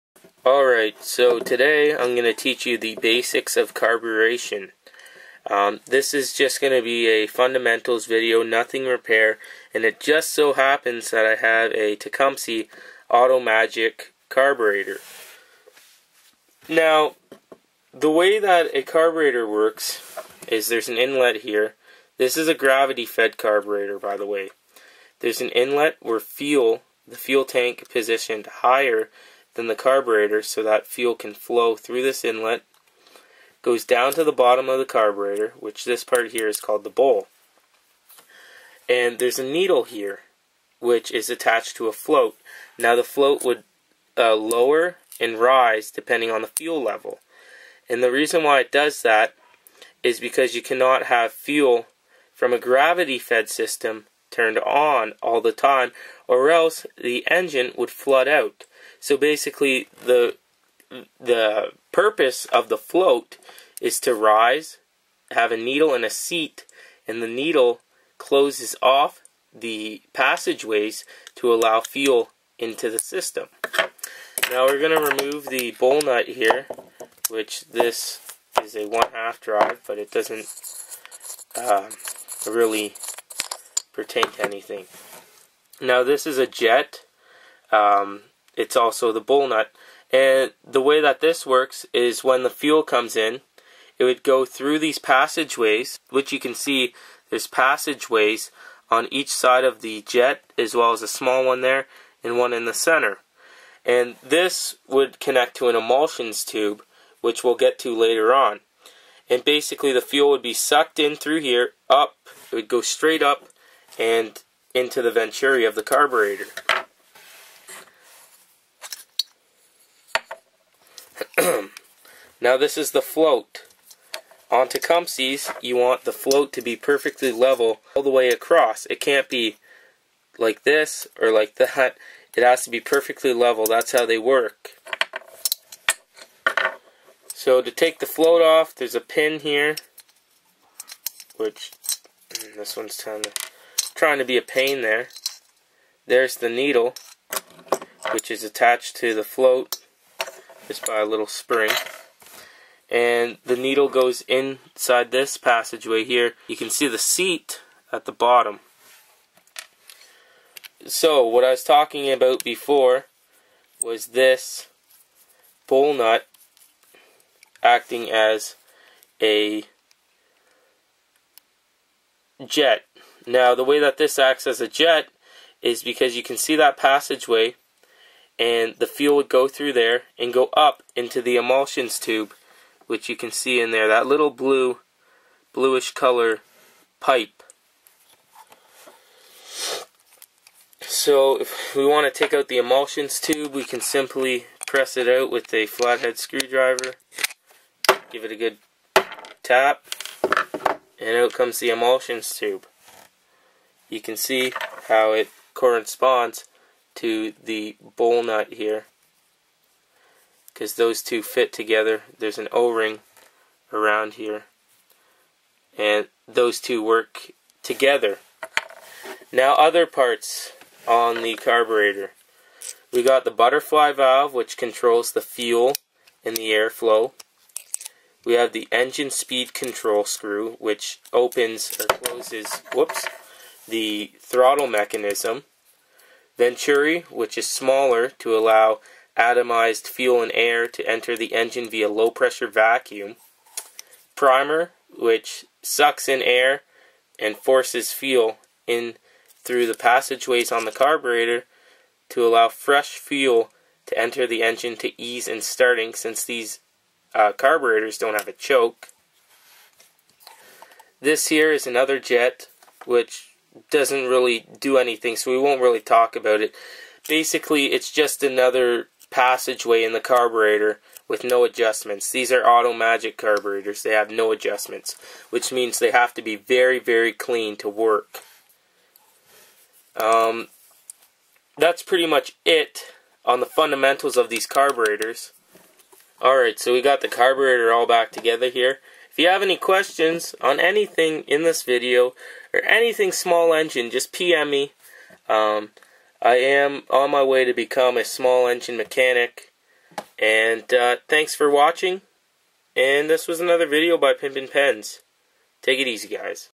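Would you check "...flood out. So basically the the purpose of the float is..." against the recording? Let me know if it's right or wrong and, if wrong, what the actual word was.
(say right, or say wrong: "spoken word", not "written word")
right.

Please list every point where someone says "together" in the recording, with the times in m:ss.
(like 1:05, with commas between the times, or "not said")
3:31, 3:37, 4:48.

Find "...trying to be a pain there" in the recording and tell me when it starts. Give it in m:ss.
2:24.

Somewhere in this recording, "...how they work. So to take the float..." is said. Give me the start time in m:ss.
2:13.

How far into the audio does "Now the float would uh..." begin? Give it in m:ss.
0:42.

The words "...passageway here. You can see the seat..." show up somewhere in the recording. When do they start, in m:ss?
2:35.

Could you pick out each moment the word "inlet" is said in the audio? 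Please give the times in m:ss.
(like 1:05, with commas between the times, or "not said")
0:20, 0:25, 0:32.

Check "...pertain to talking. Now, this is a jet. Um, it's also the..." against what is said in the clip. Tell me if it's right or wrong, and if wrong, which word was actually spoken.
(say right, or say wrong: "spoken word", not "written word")
wrong: "anything", not "talking".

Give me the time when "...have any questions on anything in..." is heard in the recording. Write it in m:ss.
4:49.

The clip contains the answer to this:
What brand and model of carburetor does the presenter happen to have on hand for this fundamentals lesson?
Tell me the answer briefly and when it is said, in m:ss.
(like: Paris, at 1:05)
Tecumseh Auto Magic, at 0:11.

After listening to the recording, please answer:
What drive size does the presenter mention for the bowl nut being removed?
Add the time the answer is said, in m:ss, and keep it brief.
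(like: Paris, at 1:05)
one half drive, at 1:18.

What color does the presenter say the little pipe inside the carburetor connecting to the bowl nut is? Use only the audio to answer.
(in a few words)
bluish.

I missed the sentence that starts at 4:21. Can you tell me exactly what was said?
This here is another jet which doesn't really do anything, so we won't really talk about it.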